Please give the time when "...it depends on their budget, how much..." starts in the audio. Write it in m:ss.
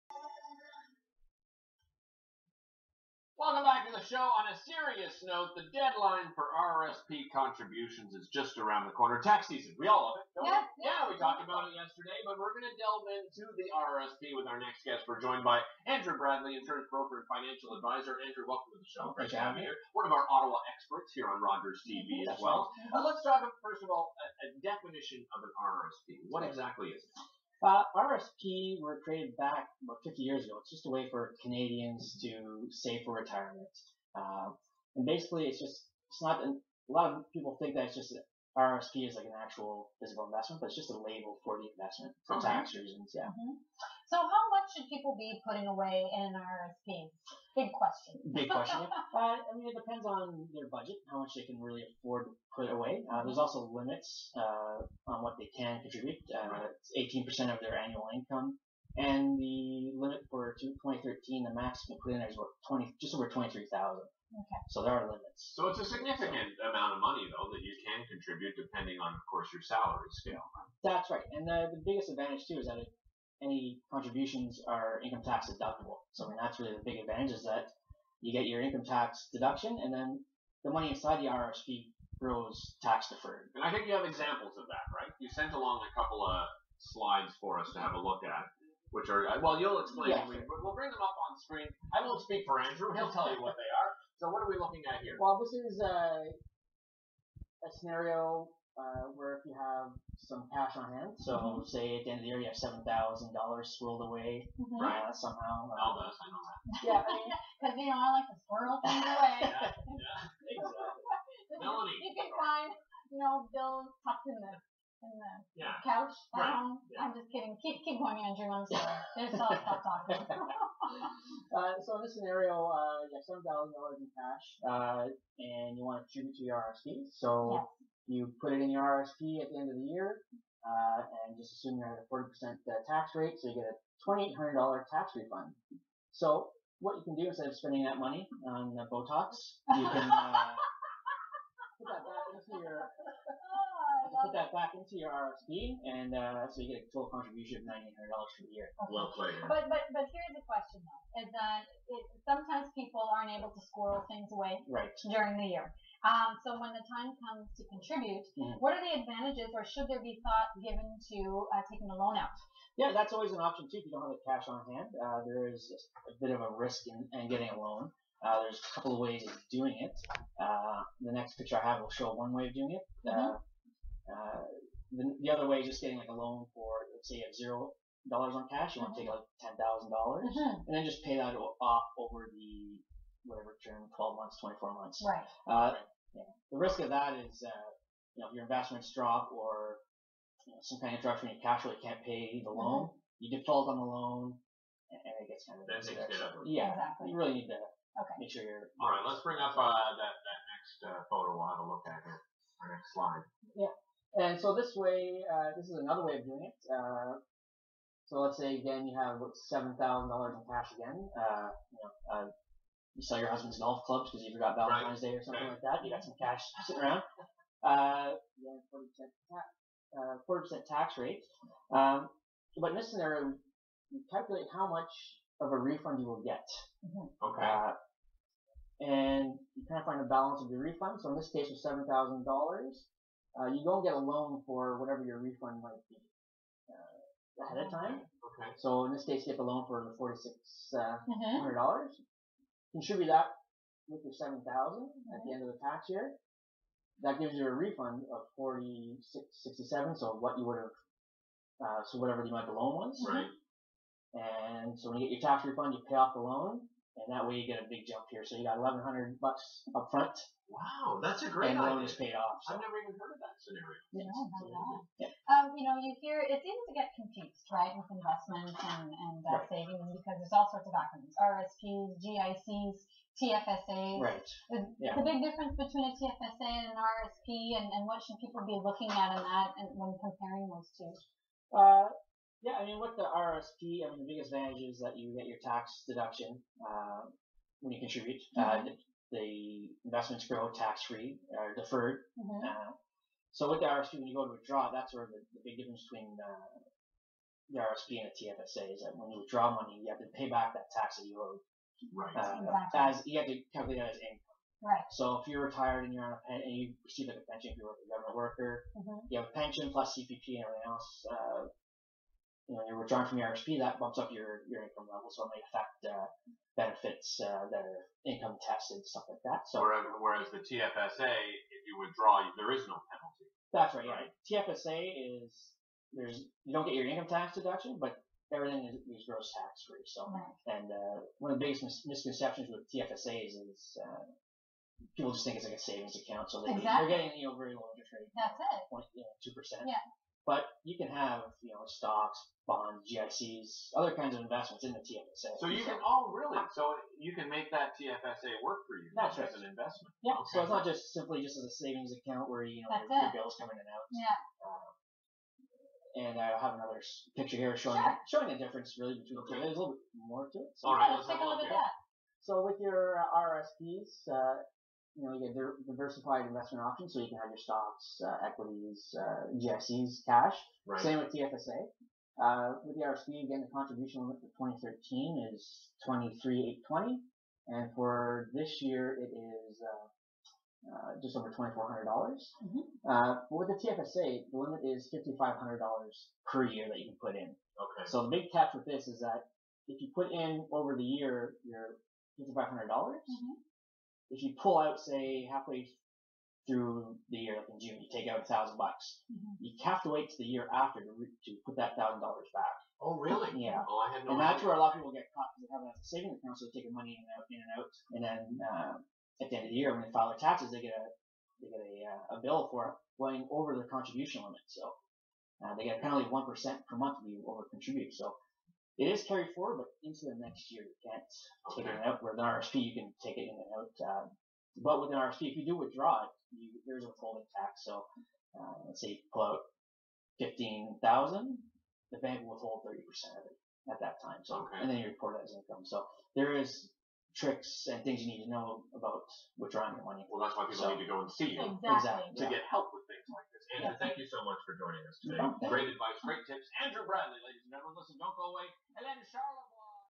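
0:49.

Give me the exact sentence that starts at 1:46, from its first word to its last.
Yeah, because I mean, you know I like to swirl things away.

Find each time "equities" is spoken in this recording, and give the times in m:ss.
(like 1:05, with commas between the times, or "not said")
6:08.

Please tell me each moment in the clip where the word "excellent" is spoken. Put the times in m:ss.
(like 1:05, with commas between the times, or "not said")
not said.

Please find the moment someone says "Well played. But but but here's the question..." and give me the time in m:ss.
2:28.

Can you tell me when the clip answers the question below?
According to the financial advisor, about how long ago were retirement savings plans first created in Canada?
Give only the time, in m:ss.
0:30.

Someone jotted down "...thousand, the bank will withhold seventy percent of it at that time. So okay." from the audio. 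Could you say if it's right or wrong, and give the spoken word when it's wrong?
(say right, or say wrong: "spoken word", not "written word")
wrong: "thirty", not "seventy".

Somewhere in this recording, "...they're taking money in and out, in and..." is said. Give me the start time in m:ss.
6:46.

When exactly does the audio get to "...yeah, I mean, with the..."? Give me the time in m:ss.
4:42.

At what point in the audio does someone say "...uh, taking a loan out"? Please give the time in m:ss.
2:41.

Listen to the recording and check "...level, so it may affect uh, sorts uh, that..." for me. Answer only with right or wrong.
wrong.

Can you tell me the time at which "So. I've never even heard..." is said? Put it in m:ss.
4:22.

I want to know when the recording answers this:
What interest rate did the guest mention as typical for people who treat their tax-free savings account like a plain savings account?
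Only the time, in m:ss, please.
5:38.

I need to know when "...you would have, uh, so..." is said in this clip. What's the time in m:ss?
4:10.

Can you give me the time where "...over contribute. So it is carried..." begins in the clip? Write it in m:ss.
6:57.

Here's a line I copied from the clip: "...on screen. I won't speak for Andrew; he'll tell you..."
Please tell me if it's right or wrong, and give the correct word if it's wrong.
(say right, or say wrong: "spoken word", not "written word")
right.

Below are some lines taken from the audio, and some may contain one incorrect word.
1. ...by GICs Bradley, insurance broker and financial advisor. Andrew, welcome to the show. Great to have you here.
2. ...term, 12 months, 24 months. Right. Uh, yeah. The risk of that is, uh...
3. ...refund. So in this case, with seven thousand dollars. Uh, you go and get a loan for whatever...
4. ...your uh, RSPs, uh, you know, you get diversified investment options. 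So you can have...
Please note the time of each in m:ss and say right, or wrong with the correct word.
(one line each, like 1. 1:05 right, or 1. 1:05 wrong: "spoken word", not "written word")
1. 0:15 wrong: "Andrew", not "GICs"
2. 3:03 right
3. 3:50 right
4. 6:02 right.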